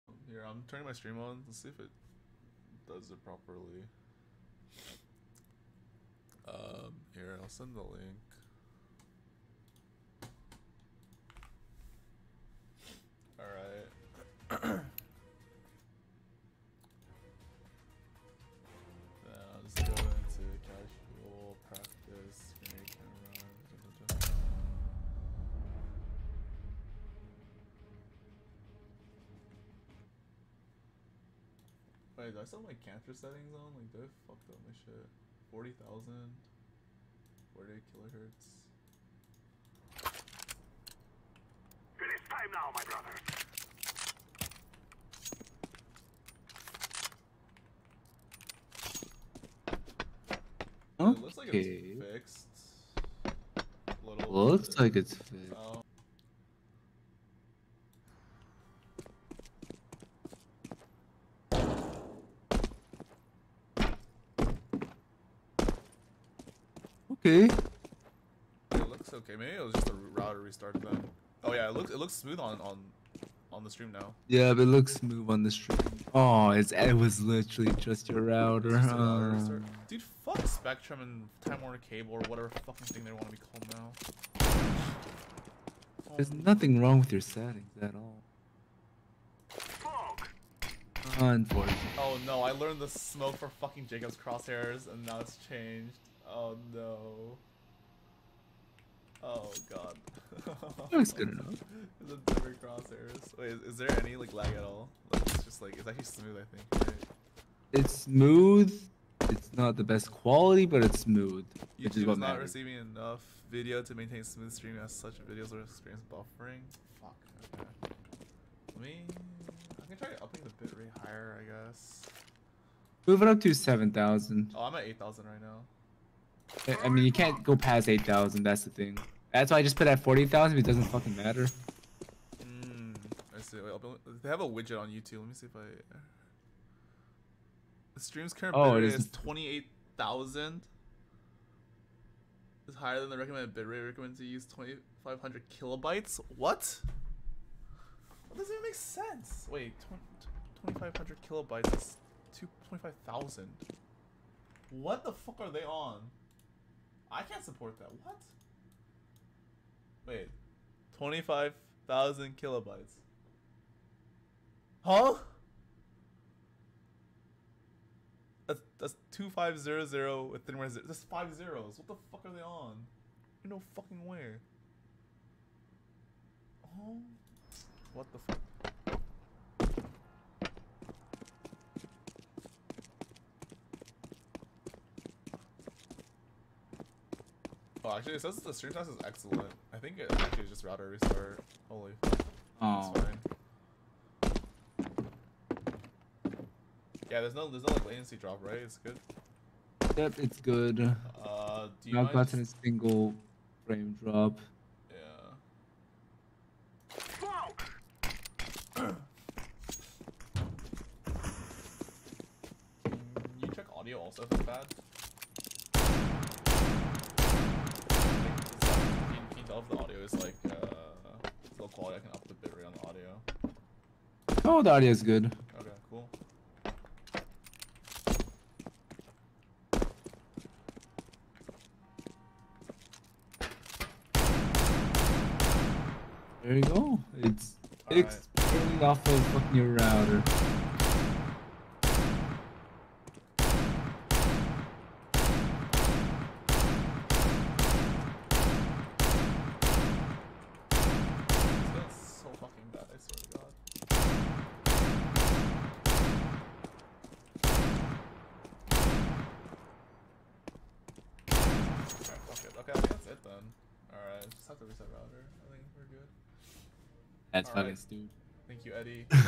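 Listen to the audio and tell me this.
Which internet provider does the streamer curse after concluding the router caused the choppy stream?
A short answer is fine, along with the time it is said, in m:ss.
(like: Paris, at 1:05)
Spectrum, at 1:20.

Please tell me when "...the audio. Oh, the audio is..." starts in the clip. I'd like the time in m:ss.
3:42.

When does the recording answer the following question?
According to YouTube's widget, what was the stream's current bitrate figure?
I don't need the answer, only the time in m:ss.
2:19.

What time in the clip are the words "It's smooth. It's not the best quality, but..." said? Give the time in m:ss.
1:47.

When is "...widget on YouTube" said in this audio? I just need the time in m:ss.
2:14.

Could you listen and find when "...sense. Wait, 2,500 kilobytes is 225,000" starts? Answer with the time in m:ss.
2:28.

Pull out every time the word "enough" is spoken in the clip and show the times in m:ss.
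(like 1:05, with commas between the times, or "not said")
1:41, 1:52.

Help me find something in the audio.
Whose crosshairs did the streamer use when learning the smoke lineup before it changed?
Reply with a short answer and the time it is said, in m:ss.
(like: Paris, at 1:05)
Jacob, at 1:33.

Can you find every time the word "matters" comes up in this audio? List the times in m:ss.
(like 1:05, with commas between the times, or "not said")
1:52, 2:11.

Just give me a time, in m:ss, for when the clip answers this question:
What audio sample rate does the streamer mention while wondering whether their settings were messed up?
0:37.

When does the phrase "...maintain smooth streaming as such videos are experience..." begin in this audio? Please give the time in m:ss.
1:53.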